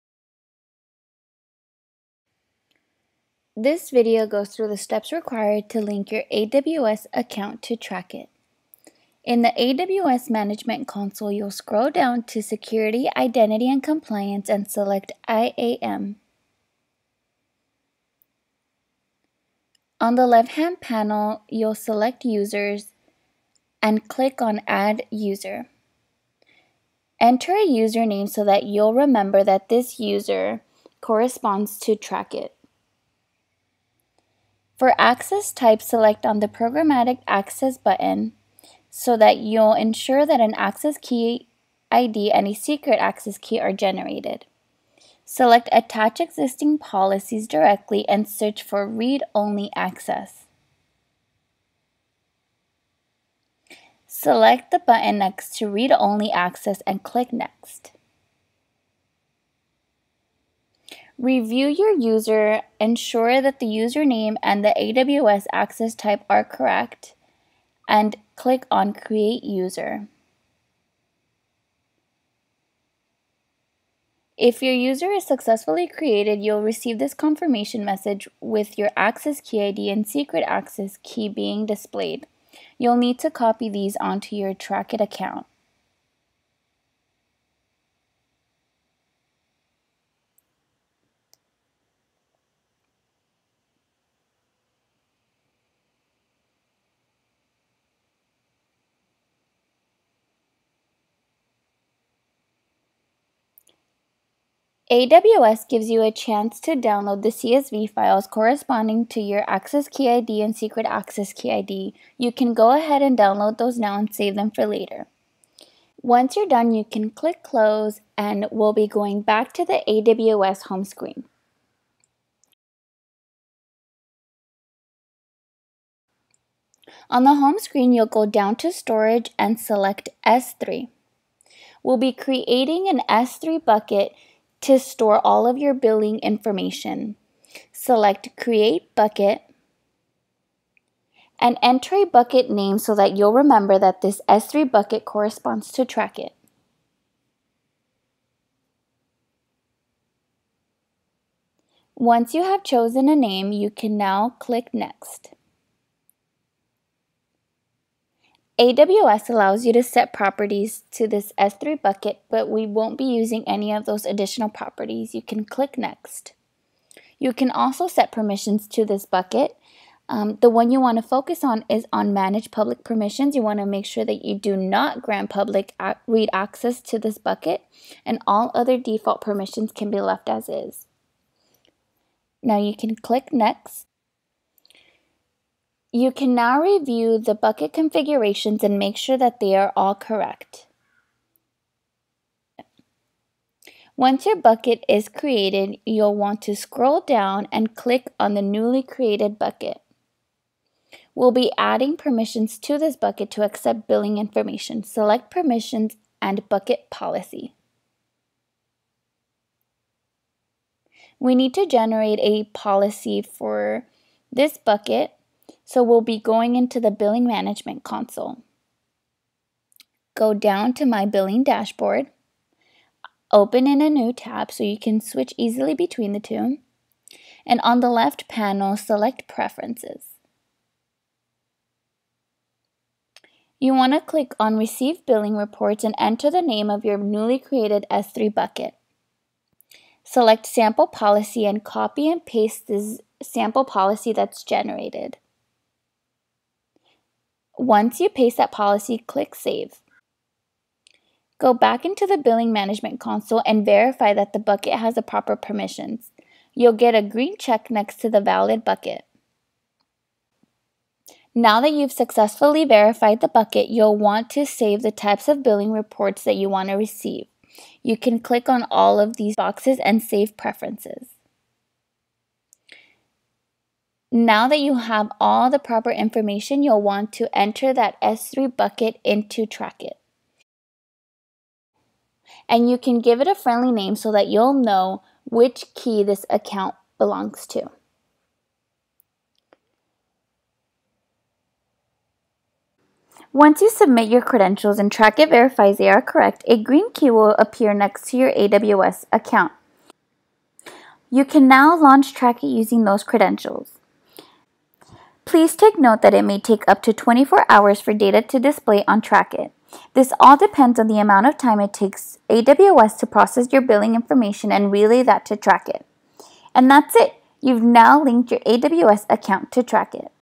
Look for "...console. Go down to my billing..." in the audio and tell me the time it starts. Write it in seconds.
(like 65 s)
217 s.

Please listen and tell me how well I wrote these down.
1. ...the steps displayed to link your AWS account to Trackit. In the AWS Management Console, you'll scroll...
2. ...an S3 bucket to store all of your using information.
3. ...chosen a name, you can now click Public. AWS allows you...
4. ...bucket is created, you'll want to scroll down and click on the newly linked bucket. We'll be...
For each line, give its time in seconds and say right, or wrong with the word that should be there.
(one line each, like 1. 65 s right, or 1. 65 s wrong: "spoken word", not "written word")
1. 4 s wrong: "required", not "displayed"
2. 132 s wrong: "billing", not "using"
3. 152 s wrong: "Next", not "Public"
4. 194 s wrong: "created", not "linked".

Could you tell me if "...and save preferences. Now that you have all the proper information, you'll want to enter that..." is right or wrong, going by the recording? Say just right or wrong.
right.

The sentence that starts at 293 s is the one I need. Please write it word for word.
Once you submit your credentials and Trackit verifies they are correct, a green key will appear next to your AWS account.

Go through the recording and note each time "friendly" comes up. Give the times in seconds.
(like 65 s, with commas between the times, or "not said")
283 s.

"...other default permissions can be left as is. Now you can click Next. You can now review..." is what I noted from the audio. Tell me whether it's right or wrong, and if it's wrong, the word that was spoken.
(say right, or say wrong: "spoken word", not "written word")
right.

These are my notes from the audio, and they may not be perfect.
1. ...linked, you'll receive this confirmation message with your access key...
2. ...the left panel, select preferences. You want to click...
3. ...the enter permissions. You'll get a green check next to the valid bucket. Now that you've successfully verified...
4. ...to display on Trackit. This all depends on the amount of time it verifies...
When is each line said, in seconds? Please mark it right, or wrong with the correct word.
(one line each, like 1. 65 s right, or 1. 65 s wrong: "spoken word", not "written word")
1. 75 s wrong: "created", not "linked"
2. 227 s right
3. 254 s wrong: "proper", not "enter"
4. 308 s wrong: "takes", not "verifies".